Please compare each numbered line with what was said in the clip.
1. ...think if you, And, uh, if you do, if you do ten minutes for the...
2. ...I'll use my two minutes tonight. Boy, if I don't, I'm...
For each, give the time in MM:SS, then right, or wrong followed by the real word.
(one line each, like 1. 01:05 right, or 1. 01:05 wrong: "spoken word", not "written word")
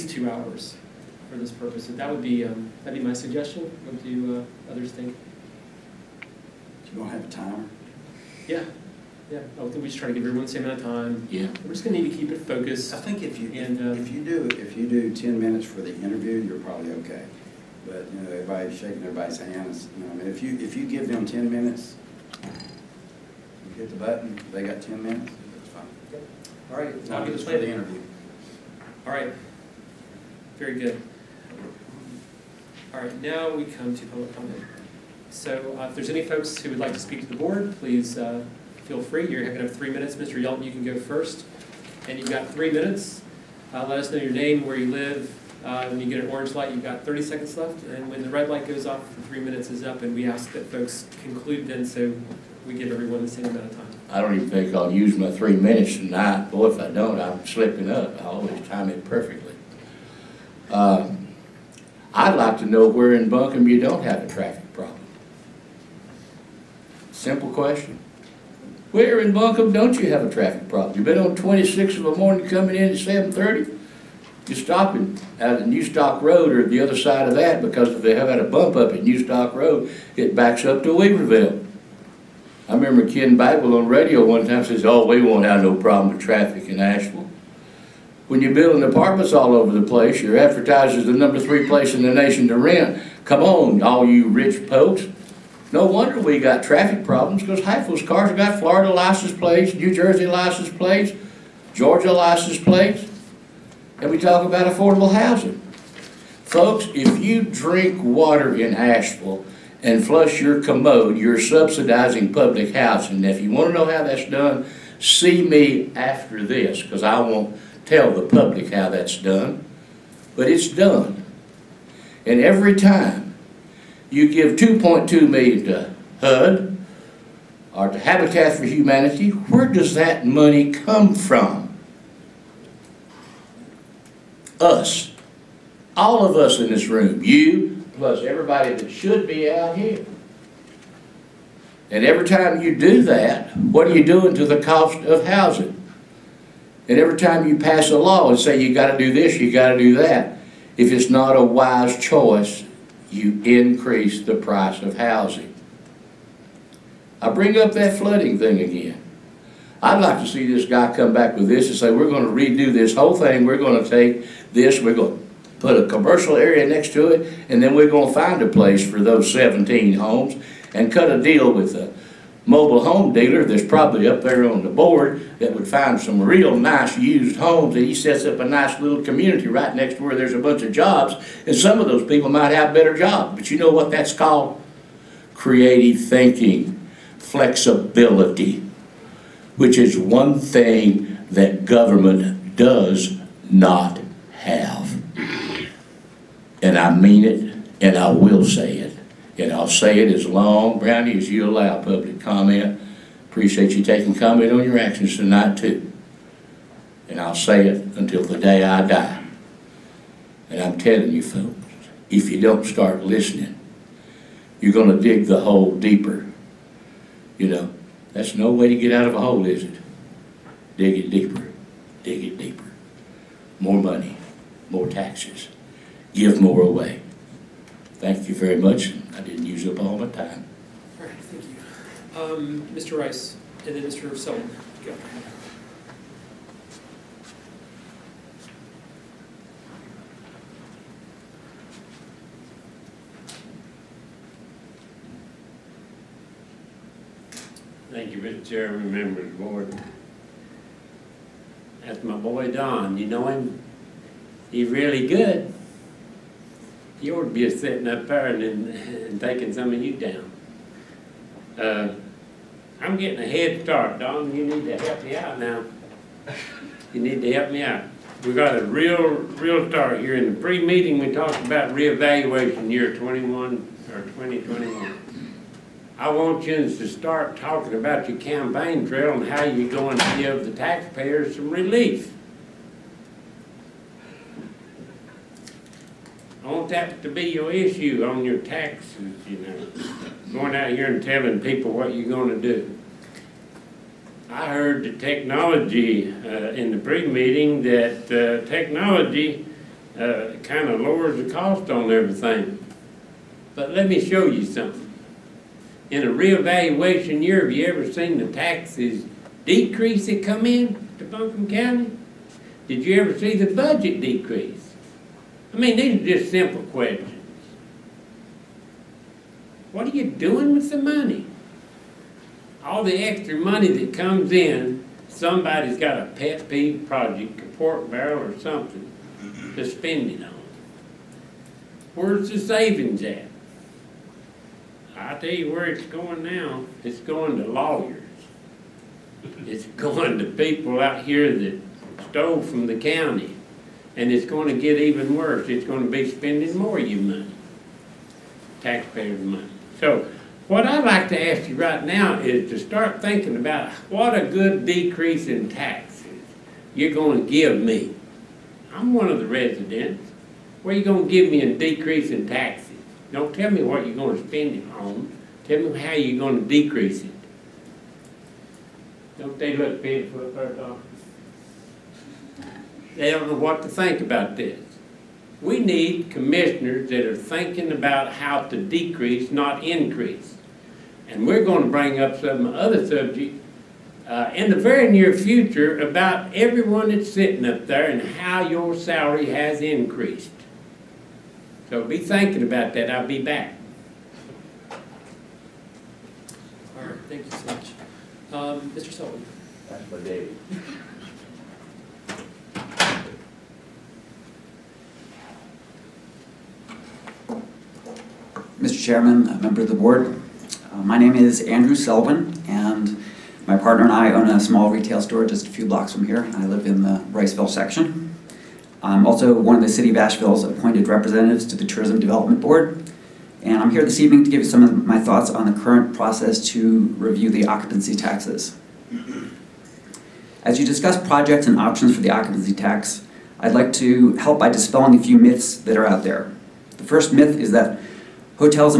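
1. 00:12 right
2. 00:54 wrong: "three", not "two".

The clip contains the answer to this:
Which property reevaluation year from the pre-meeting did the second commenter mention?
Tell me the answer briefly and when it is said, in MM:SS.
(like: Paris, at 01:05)
2021, at 04:34.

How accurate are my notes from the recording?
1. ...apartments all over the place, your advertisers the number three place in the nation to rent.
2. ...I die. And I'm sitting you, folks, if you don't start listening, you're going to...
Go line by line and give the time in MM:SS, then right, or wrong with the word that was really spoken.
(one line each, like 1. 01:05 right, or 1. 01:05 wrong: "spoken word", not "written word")
1. 01:28 right
2. 03:28 wrong: "telling", not "sitting".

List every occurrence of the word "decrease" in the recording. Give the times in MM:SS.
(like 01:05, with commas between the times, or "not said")
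05:09, 05:14, 05:54, 06:01, 06:06, 06:18.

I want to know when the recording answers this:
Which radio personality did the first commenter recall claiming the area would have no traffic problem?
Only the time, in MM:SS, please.
01:23.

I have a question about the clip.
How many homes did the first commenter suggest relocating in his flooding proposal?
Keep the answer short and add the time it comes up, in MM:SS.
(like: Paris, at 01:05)
17, at 02:49.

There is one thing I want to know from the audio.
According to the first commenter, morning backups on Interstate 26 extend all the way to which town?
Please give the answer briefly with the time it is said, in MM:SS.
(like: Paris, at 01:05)
Weaverville, at 01:20.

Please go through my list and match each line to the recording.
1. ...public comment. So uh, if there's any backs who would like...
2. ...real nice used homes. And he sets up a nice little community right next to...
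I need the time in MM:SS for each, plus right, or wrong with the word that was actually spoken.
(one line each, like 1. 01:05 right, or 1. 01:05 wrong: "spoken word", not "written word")
1. 00:34 wrong: "folks", not "backs"
2. 02:56 right.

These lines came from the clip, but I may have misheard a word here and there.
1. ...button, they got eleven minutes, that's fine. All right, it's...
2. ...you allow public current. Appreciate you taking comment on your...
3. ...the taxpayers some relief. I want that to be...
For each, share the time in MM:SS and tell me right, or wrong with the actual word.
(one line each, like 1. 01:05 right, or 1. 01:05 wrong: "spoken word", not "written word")
1. 00:23 wrong: "ten", not "eleven"
2. 03:21 wrong: "comment", not "current"
3. 04:40 right.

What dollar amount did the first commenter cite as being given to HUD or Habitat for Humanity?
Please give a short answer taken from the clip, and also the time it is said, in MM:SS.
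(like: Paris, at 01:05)
2.2 million, at 02:04.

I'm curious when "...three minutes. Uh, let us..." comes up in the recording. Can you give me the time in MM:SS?
00:42.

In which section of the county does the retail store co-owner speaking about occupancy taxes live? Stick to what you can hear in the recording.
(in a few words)
Riceville.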